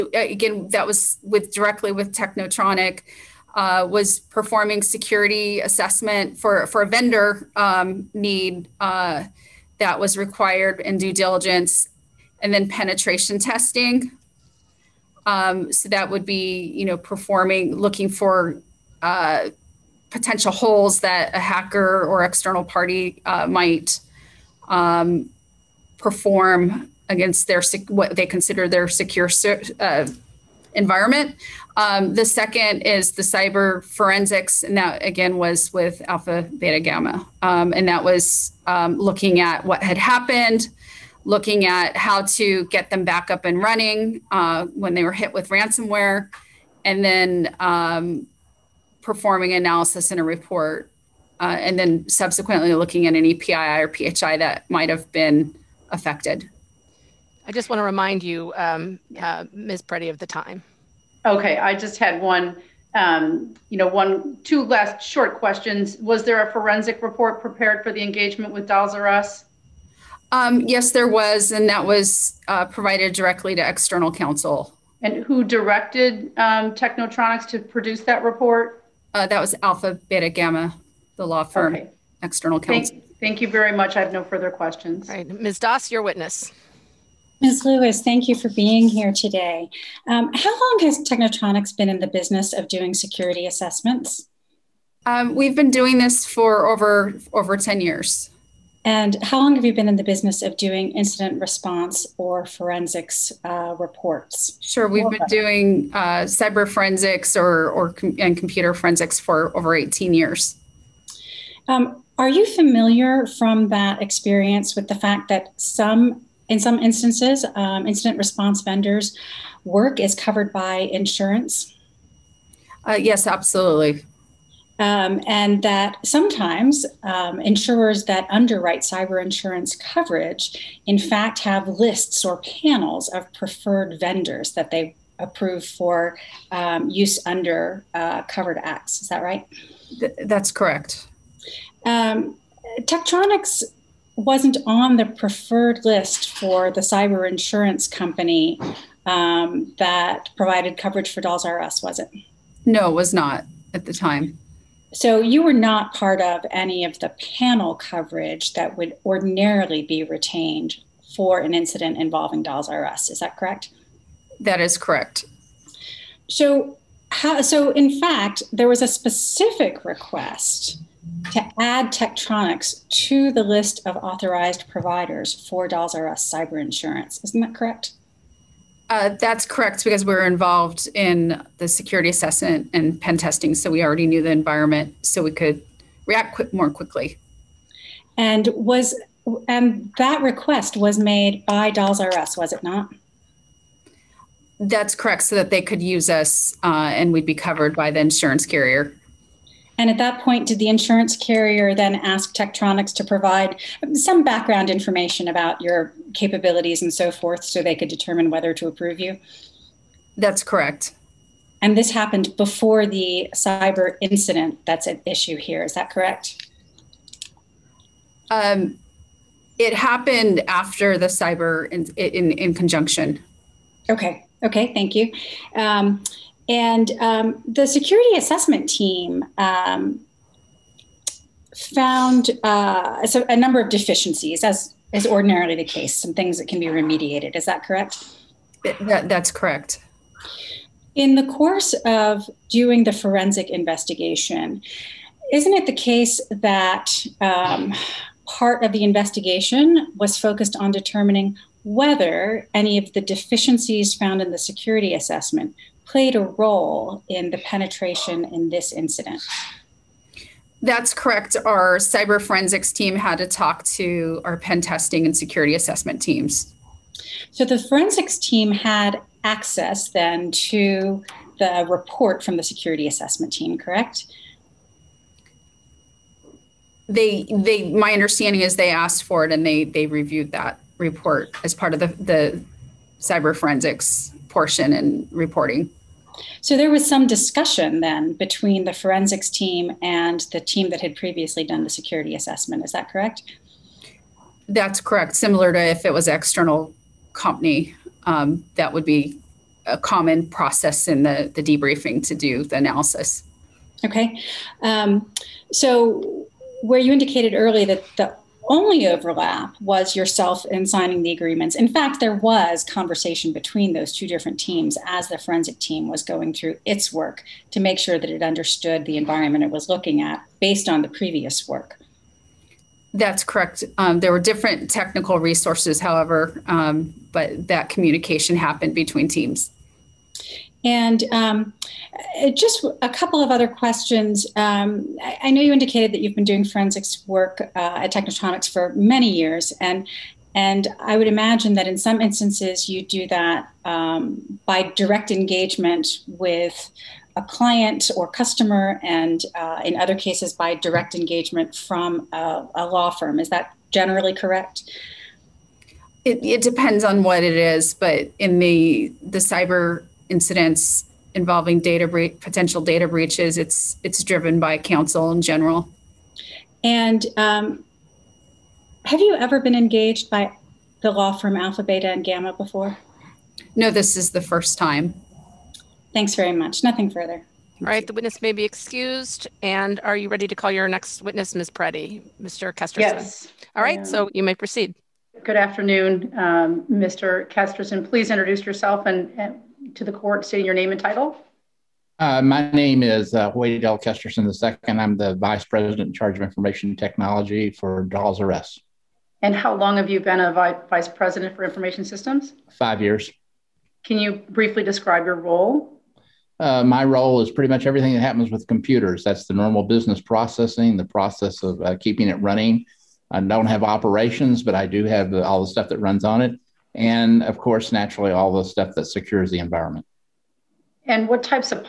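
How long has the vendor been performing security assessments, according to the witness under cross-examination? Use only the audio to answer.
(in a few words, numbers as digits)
Over 10 years.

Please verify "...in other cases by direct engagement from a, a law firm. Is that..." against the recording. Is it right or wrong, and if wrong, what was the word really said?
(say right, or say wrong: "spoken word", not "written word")
right.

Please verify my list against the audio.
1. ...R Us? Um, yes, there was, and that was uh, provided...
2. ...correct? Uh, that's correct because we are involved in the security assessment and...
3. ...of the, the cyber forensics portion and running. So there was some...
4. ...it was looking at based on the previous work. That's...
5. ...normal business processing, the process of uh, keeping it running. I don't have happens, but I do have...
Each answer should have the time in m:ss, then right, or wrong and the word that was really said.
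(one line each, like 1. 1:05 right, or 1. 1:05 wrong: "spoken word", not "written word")
1. 1:08 right
2. 2:57 right
3. 4:41 wrong: "reporting", not "running"
4. 5:19 right
5. 6:49 wrong: "operations", not "happens".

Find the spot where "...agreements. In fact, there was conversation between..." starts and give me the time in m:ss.
5:11.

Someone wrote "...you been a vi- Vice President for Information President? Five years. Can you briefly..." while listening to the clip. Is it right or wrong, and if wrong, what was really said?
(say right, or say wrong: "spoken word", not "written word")
wrong: "Systems", not "President".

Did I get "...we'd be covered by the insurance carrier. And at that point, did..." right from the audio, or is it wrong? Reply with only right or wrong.
right.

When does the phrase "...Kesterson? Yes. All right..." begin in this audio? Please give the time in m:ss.
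6:22.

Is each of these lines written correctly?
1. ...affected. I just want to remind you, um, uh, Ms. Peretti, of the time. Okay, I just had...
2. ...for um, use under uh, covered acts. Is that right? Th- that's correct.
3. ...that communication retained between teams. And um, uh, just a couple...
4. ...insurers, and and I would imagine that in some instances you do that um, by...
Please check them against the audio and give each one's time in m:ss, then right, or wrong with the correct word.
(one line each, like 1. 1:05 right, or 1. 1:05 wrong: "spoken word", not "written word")
1. 0:55 right
2. 2:15 right
3. 5:27 wrong: "happened", not "retained"
4. 5:39 wrong: "years", not "insurers".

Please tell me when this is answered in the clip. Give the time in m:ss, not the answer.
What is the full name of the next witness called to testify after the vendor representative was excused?
6:33.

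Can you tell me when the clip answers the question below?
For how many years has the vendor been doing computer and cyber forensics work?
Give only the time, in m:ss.
1:49.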